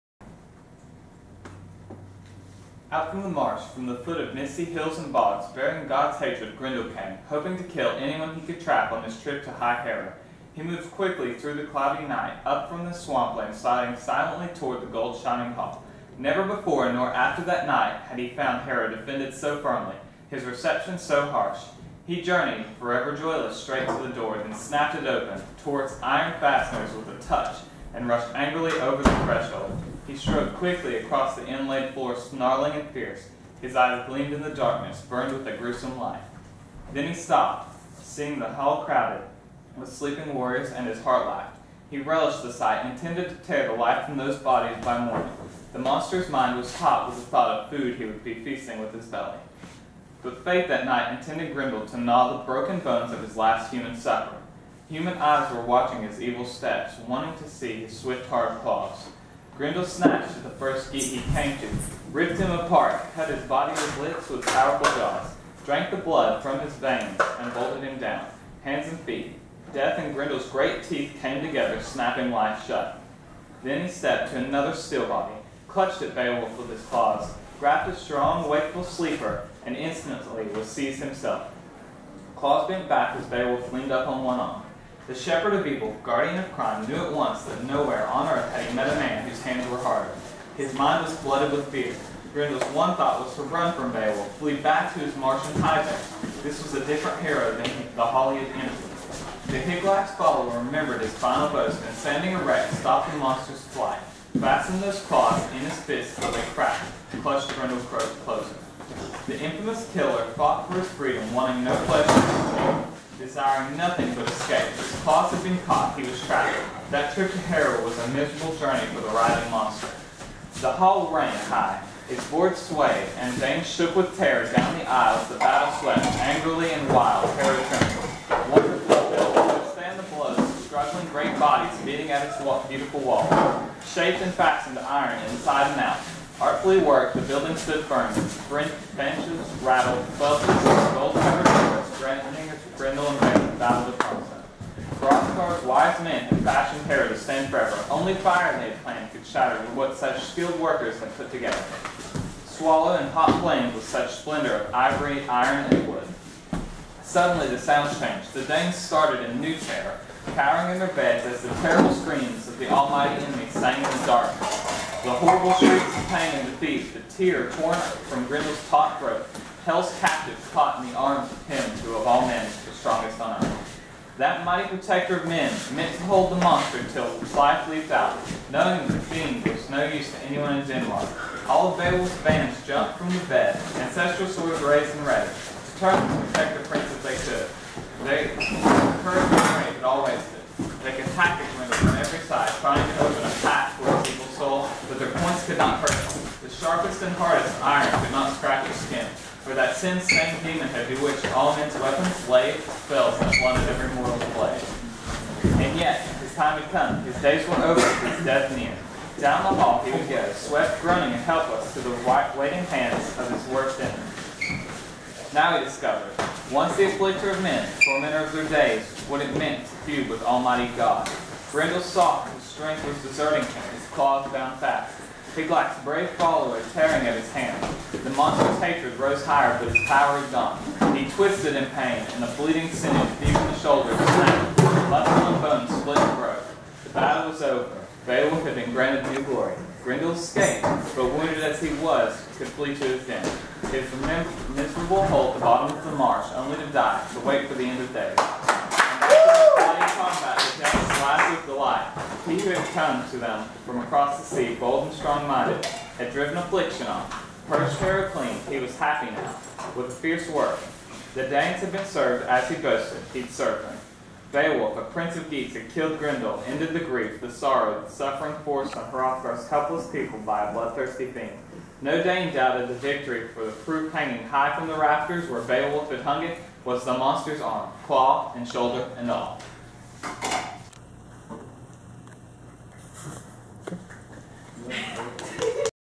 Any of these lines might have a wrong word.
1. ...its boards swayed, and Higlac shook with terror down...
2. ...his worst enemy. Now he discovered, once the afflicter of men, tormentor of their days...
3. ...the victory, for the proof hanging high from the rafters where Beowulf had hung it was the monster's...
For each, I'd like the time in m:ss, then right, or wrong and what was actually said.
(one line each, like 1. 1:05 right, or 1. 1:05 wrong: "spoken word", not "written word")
1. 2:02 wrong: "Dane", not "Higlac"
2. 3:33 right
3. 4:32 right.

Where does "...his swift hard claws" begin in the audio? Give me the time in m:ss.
0:57.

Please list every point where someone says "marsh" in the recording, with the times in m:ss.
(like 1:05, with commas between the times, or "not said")
0:03, 4:05.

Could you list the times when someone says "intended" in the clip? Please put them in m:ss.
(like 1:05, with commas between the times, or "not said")
0:42, 0:51.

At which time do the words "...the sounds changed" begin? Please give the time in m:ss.
2:37.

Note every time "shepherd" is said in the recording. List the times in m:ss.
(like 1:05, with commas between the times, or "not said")
1:25.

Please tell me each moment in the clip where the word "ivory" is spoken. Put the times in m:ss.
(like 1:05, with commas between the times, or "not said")
2:34.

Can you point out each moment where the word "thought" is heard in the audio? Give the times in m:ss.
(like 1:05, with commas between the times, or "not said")
0:47, 1:32.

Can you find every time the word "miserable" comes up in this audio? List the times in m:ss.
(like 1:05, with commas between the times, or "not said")
1:58, 4:04.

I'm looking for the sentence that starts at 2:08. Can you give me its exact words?
Wonderful built to the blows, struggling great bodies beating at its beautiful wall, shaped and fastened to iron inside and out.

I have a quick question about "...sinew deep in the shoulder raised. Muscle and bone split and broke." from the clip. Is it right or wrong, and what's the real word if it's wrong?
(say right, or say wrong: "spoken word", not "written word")
wrong: "snapped", not "raised".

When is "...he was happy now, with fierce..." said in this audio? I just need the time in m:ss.
4:18.